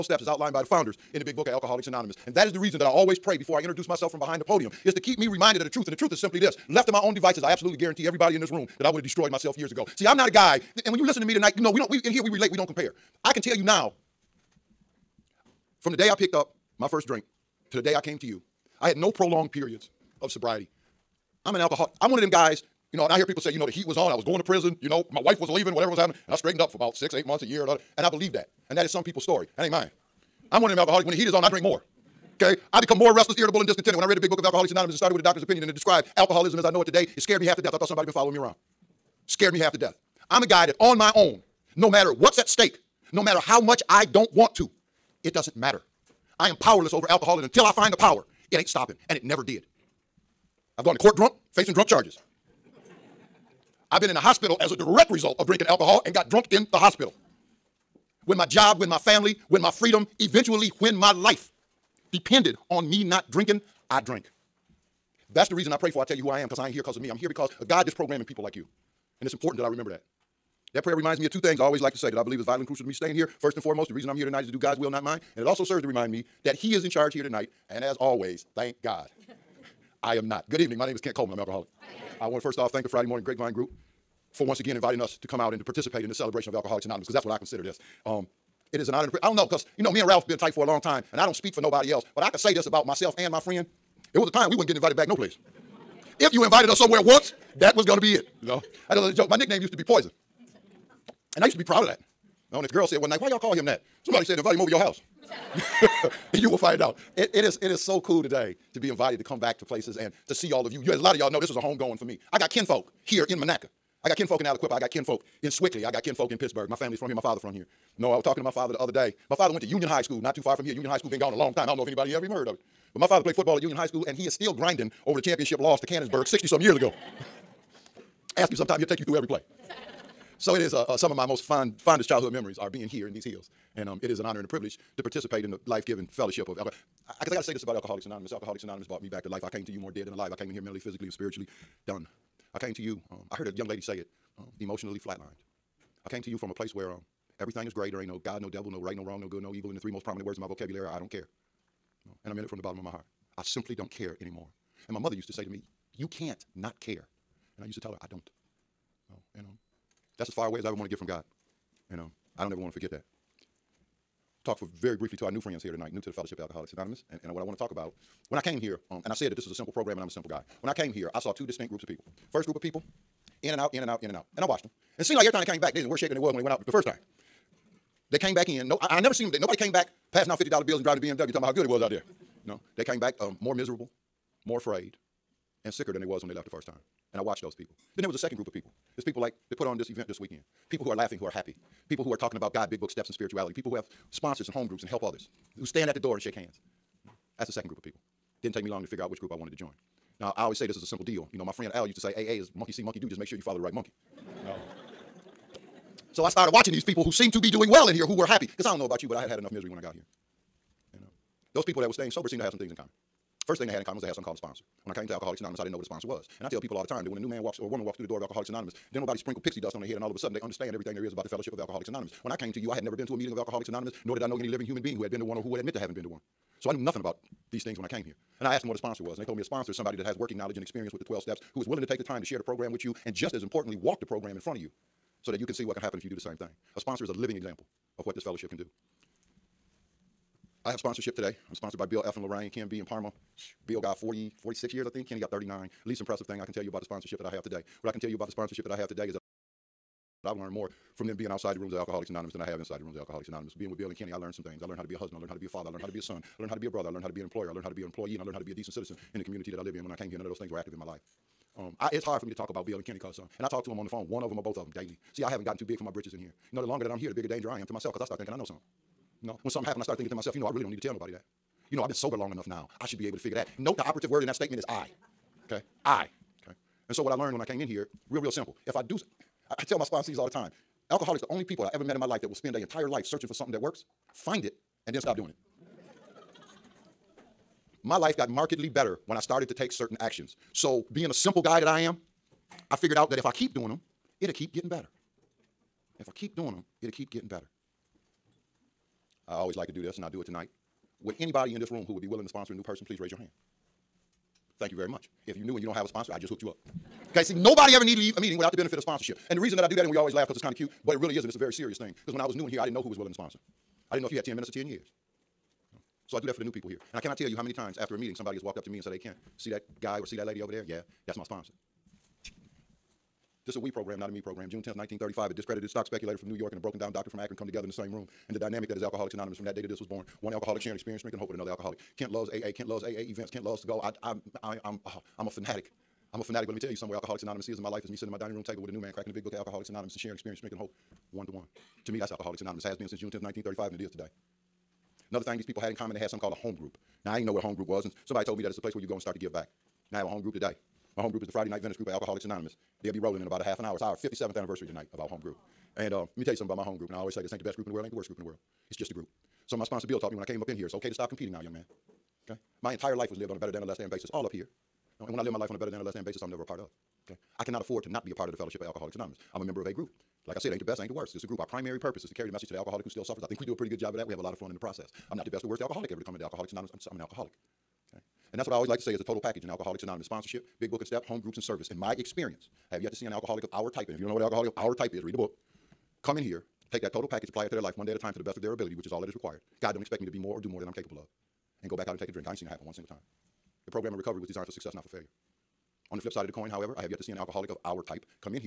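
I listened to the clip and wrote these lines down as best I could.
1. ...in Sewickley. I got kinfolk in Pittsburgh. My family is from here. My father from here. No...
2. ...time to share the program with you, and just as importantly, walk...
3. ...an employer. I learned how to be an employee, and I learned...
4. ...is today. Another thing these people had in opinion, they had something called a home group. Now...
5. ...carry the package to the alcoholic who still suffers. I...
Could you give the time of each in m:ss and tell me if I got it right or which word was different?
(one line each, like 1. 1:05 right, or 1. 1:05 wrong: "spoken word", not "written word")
1. 1:55 right
2. 3:52 right
3. 4:17 right
4. 5:43 wrong: "common", not "opinion"
5. 6:12 wrong: "message", not "package".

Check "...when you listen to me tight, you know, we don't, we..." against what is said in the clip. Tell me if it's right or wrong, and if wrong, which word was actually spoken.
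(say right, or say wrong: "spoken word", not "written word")
wrong: "tonight", not "tight".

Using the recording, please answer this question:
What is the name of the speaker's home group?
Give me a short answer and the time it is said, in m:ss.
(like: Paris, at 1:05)
Friday Night Venice group, at 5:51.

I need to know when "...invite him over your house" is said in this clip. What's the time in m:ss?
1:44.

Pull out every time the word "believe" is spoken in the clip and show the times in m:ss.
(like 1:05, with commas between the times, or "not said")
0:28, 1:12.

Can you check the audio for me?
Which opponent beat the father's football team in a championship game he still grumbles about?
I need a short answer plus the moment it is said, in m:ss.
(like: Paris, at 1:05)
Canonsburg, at 2:05.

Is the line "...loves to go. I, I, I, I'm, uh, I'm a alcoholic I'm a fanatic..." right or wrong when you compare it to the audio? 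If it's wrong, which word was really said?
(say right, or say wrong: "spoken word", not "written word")
wrong: "fanatic", not "alcoholic".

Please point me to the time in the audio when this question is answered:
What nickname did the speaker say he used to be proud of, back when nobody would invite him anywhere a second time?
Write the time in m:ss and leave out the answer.
1:39.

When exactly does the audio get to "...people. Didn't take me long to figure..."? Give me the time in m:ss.
3:17.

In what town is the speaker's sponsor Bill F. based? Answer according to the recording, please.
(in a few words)
Lorain.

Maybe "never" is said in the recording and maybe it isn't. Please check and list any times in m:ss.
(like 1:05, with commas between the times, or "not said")
0:49, 2:58, 3:42, 6:06.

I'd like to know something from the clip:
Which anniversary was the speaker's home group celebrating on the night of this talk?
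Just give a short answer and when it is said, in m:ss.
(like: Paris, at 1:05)
57th, at 5:53.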